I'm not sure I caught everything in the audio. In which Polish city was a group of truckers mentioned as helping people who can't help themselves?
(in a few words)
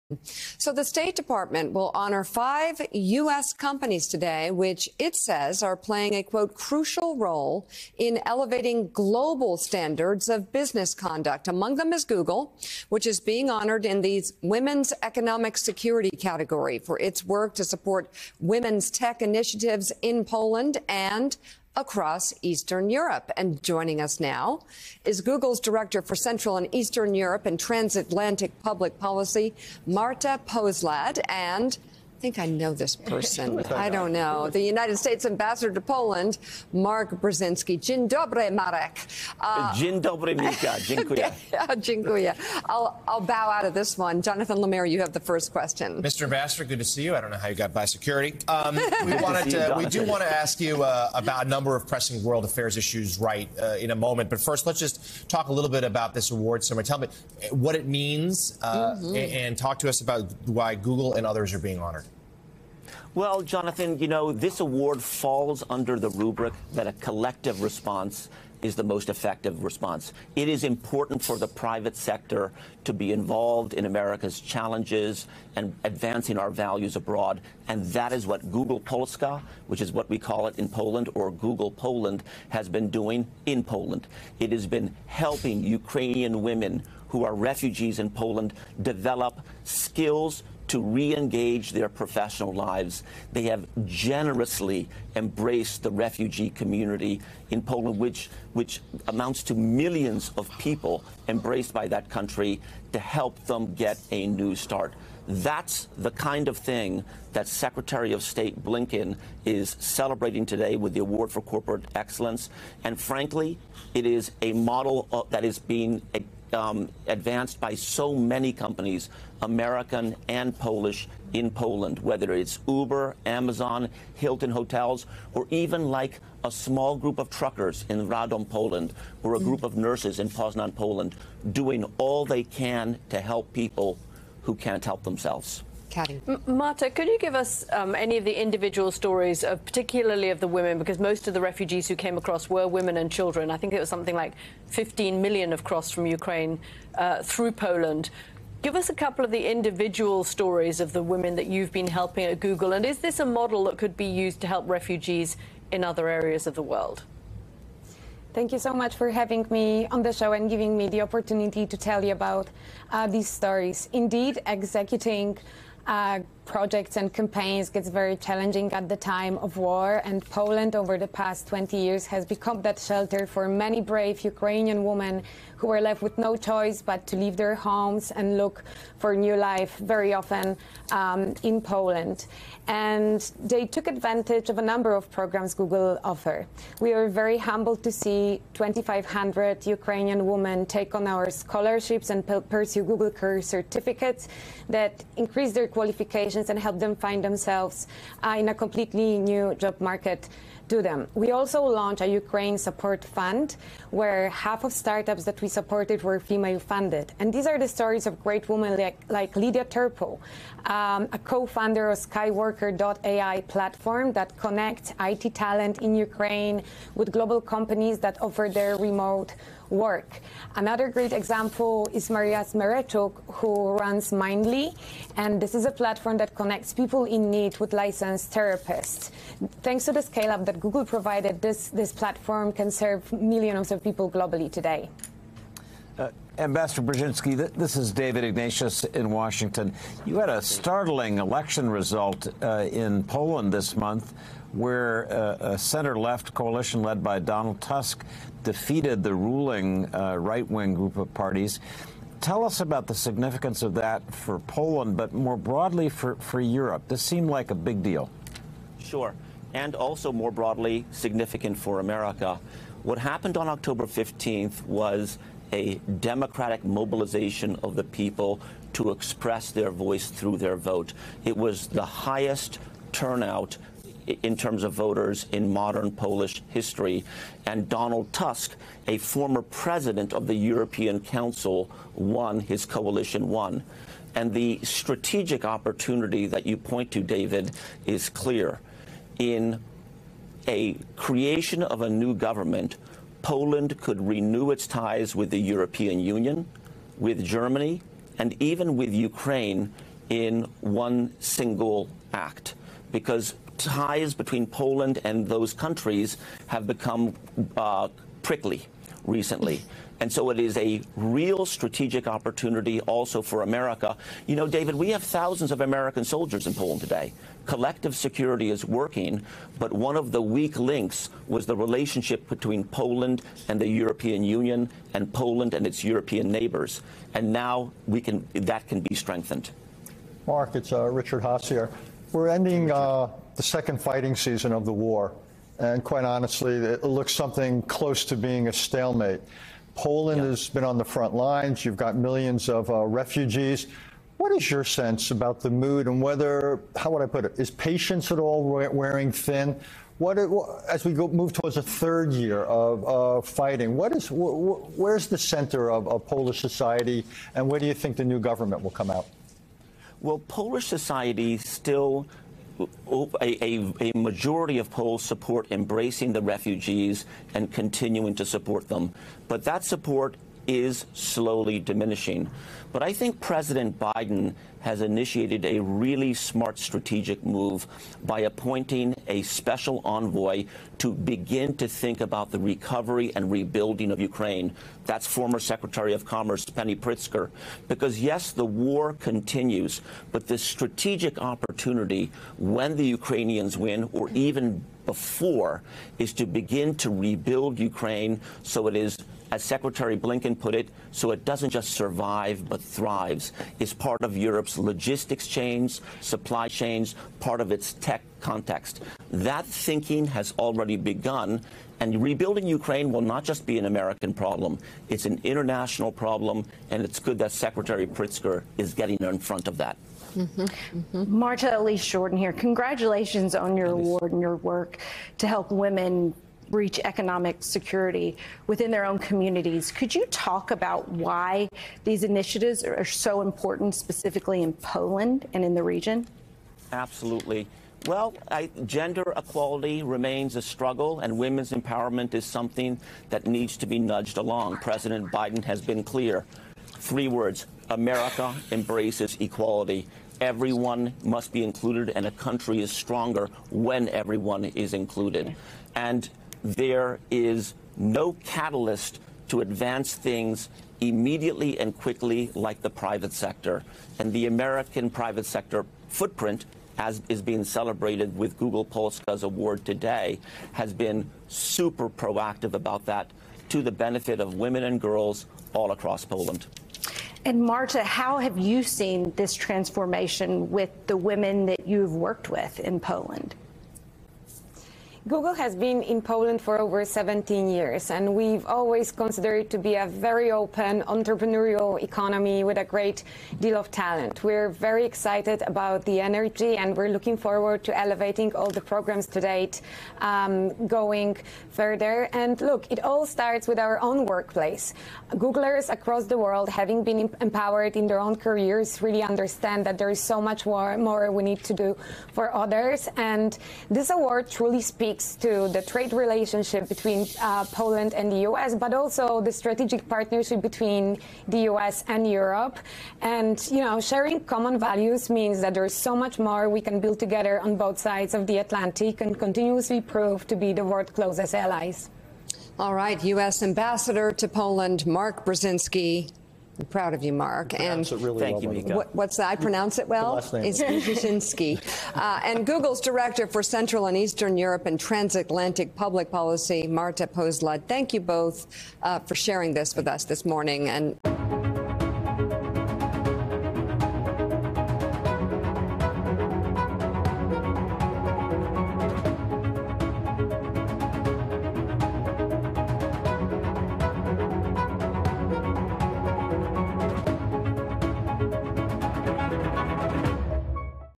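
Radom.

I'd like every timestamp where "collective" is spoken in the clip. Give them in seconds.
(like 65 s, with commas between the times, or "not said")
66 s, 317 s.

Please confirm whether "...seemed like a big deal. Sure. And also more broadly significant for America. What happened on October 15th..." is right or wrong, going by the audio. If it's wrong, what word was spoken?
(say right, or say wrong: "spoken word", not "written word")
right.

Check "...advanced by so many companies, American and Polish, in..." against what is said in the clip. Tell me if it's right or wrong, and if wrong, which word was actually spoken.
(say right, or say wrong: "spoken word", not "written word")
right.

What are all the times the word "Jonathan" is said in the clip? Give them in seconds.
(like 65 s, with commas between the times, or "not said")
44 s, 63 s.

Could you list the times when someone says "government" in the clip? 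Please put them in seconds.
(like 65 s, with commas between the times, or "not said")
292 s, 358 s.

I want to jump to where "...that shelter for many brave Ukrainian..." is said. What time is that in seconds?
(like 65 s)
172 s.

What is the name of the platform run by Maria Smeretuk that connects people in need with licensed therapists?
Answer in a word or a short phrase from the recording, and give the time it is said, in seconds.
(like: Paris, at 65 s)
Mindly, at 224 s.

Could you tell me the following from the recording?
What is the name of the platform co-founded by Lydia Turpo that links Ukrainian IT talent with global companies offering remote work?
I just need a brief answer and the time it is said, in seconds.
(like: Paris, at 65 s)
Skyworker.ai, at 212 s.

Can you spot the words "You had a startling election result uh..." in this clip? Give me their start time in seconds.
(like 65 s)
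240 s.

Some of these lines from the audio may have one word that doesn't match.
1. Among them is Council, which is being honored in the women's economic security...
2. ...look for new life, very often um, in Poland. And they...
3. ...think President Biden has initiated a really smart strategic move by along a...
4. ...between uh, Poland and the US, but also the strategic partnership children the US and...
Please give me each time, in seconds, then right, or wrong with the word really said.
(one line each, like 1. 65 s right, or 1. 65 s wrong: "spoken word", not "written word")
1. 11 s wrong: "Google", not "Council"
2. 178 s right
3. 372 s wrong: "appointing", not "along"
4. 516 s wrong: "between", not "children".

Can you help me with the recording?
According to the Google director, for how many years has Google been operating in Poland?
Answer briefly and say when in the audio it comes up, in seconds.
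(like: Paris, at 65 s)
over 17 years, at 486 s.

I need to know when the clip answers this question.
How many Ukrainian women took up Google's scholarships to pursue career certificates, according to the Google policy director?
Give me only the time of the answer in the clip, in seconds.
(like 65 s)
188 s.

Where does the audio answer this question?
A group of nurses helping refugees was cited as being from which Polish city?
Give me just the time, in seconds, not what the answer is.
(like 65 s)
130 s.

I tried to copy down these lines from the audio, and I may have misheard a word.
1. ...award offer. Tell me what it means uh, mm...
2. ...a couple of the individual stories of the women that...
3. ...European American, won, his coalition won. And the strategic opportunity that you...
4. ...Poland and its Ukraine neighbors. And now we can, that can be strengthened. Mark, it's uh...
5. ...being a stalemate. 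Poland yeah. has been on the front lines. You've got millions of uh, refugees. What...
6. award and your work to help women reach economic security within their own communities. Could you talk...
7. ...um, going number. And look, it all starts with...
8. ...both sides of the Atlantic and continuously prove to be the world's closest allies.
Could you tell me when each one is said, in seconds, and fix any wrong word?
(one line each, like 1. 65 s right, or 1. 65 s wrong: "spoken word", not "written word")
1. 56 s wrong: "summer", not "offer"
2. 148 s right
3. 280 s wrong: "Council", not "American"
4. 325 s wrong: "European", not "Ukraine"
5. 338 s right
6. 423 s right
7. 500 s wrong: "further", not "number"
8. 527 s right.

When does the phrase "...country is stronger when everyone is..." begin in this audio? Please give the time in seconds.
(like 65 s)
452 s.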